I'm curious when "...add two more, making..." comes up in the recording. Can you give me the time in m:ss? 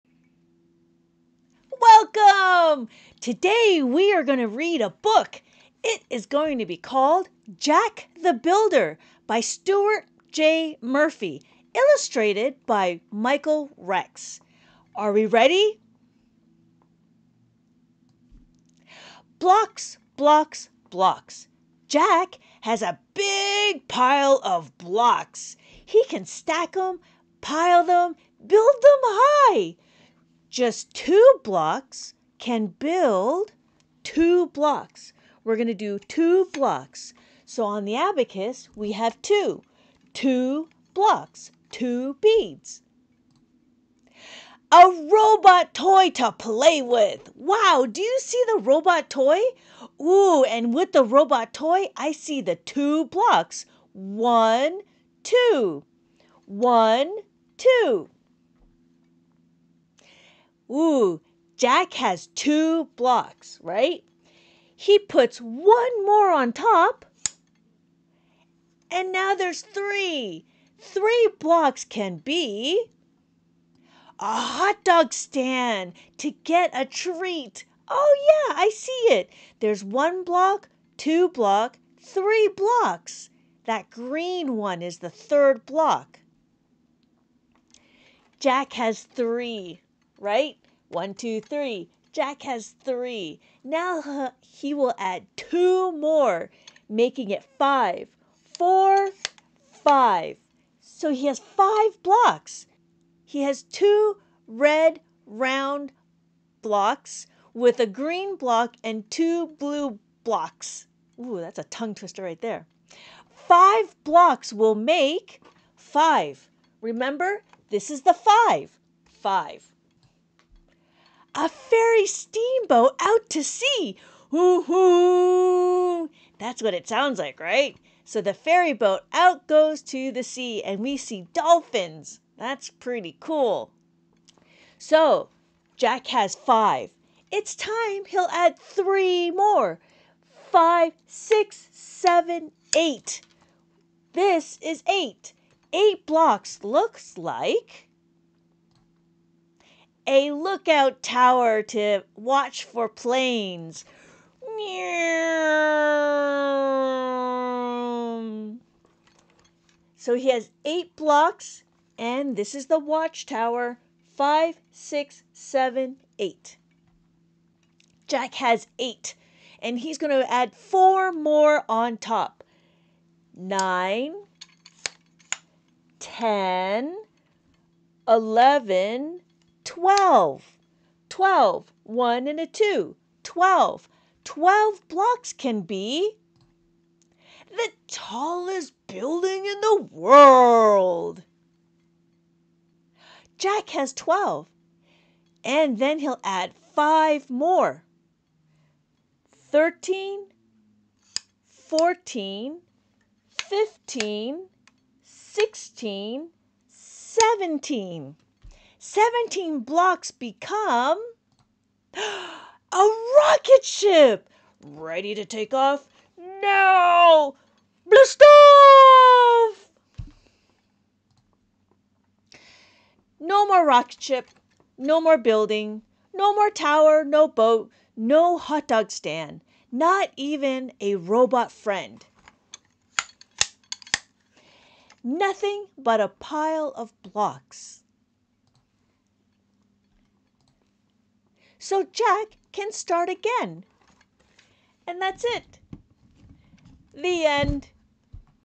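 1:34.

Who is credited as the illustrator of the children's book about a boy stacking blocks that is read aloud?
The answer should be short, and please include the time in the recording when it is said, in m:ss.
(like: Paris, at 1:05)
Michael Rex, at 0:13.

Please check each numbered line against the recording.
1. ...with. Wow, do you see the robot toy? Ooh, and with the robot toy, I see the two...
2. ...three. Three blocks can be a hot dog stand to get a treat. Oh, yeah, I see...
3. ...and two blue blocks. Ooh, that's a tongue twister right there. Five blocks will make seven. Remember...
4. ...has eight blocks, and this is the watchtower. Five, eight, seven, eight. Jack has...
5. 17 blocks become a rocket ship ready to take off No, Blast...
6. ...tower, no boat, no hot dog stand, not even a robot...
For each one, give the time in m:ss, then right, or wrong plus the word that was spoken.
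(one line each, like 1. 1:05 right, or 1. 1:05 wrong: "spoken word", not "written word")
1. 0:46 right
2. 1:09 right
3. 1:48 wrong: "five", not "seven"
4. 2:40 wrong: "six", not "eight"
5. 3:28 right
6. 3:46 right.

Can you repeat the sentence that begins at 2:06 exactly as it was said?
That's what it sounds like, right?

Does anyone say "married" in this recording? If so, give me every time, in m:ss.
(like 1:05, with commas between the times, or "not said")
not said.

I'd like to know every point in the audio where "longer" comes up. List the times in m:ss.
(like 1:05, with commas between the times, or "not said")
not said.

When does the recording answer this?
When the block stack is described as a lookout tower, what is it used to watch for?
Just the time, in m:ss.
2:32.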